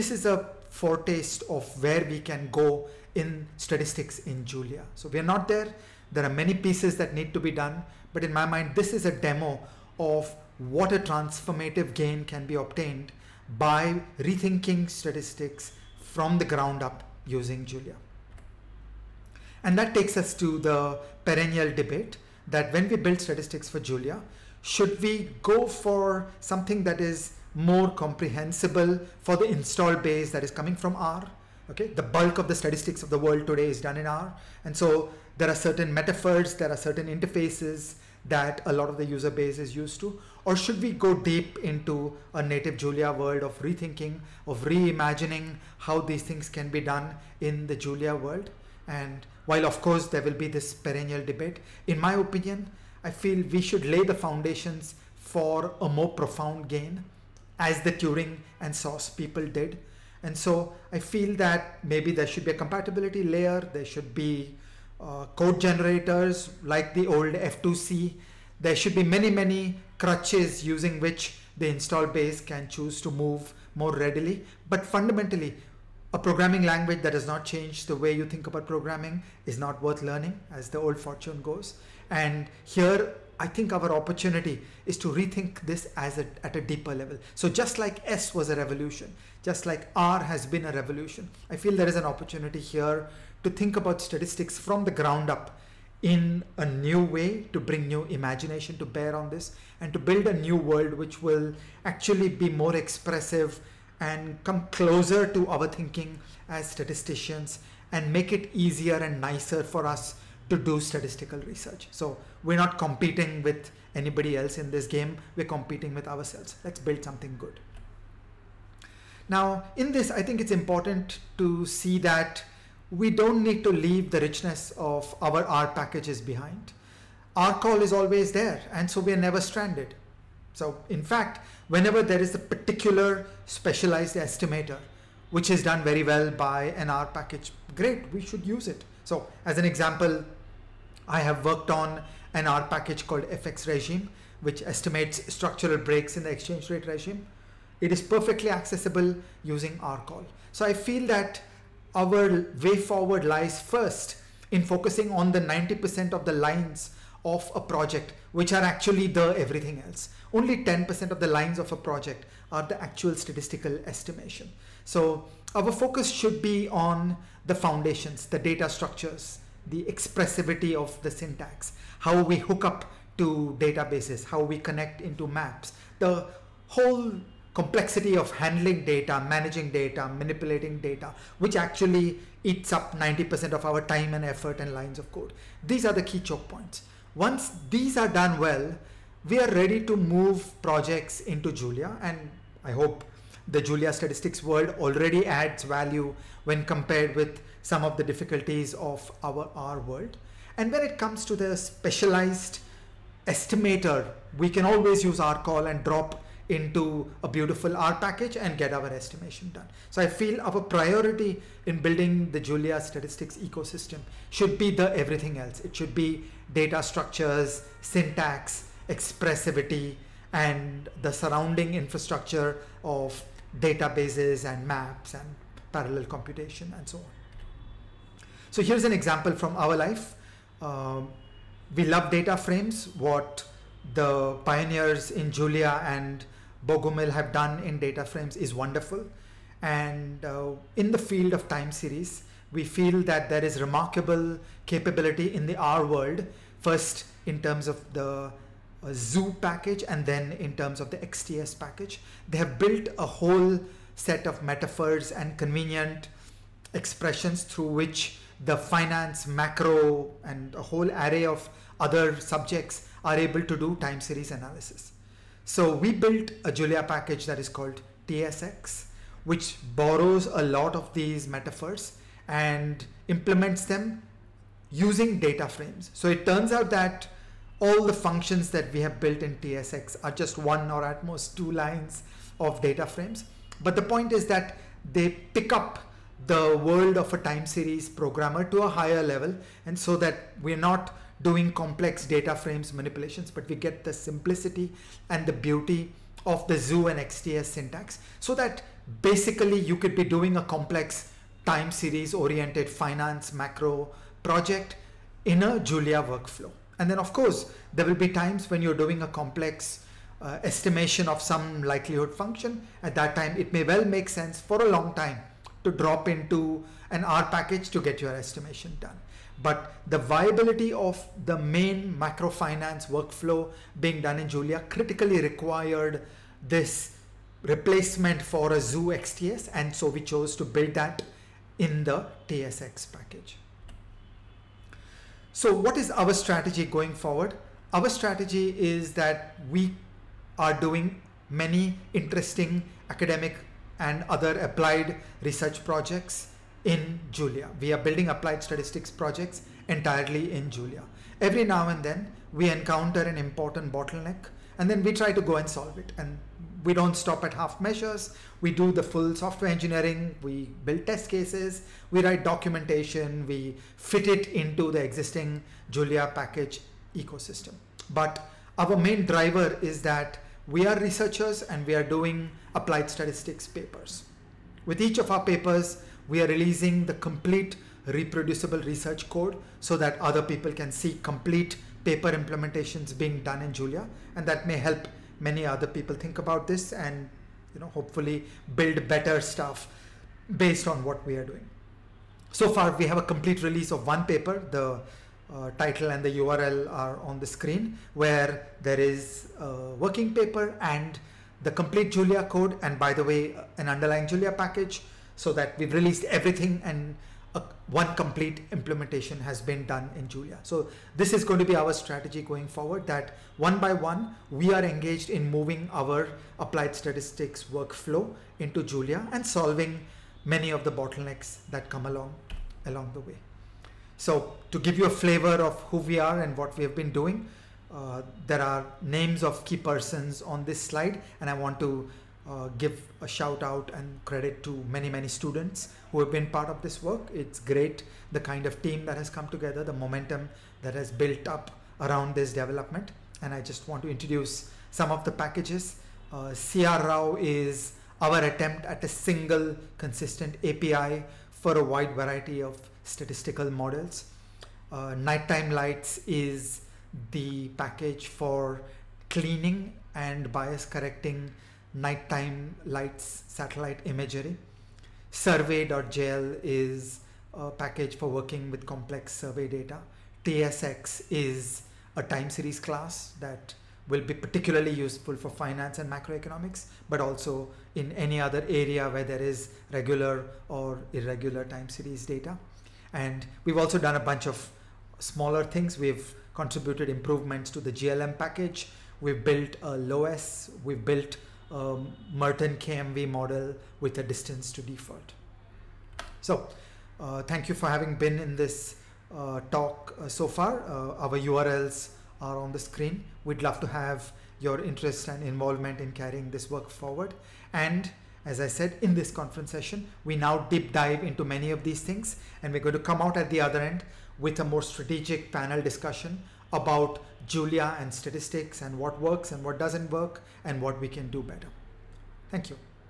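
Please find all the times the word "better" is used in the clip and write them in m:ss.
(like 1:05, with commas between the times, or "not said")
6:28, 8:41.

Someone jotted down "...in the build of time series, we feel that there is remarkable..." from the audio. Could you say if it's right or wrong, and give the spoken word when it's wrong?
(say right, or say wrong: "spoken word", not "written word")
wrong: "field", not "build".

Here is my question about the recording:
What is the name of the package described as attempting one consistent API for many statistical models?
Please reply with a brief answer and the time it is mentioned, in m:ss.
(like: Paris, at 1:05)
CR Rao, at 7:26.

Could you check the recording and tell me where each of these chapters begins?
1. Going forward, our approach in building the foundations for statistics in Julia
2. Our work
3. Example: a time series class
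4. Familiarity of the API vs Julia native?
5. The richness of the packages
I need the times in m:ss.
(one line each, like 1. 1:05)
1. 5:34
2. 7:03
3. 3:47
4. 0:17
5. 1:57.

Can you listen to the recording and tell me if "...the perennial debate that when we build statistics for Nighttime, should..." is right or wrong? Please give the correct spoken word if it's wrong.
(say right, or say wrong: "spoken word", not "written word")
wrong: "Julia", not "Nighttime".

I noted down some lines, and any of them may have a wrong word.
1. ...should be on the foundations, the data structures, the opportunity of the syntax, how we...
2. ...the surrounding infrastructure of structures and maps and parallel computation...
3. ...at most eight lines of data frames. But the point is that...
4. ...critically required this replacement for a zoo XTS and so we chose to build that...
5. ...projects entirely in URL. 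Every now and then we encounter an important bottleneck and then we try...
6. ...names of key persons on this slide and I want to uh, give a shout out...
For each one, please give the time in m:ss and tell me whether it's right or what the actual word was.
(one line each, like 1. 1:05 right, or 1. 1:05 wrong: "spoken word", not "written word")
1. 2:46 wrong: "expressivity", not "opportunity"
2. 3:41 wrong: "databases", not "structures"
3. 4:40 wrong: "two", not "eight"
4. 5:24 right
5. 5:48 wrong: "Julia", not "URL"
6. 7:08 right.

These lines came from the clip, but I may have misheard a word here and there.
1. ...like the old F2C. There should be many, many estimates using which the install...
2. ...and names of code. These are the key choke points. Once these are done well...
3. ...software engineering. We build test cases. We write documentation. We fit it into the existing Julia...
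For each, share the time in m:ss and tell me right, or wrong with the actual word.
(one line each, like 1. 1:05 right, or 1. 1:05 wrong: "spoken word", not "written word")
1. 1:06 wrong: "crutches", not "estimates"
2. 3:04 wrong: "lines", not "names"
3. 5:59 right.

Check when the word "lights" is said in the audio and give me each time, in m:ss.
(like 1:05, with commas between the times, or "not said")
7:35, 7:42.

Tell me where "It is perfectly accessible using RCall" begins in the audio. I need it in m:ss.
2:27.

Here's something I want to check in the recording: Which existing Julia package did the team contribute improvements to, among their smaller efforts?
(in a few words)
GLM.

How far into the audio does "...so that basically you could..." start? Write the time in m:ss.
4:58.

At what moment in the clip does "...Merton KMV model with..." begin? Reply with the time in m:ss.
8:12.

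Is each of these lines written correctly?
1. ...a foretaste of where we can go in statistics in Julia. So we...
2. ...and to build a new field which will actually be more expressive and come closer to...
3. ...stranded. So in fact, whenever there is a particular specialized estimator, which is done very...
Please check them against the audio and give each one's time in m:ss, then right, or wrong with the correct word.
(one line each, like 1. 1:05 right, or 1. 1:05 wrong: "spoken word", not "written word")
1. 0:00 right
2. 1:39 wrong: "world", not "field"
3. 2:09 right.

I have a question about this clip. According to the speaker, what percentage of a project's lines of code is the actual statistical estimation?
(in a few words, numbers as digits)
10%.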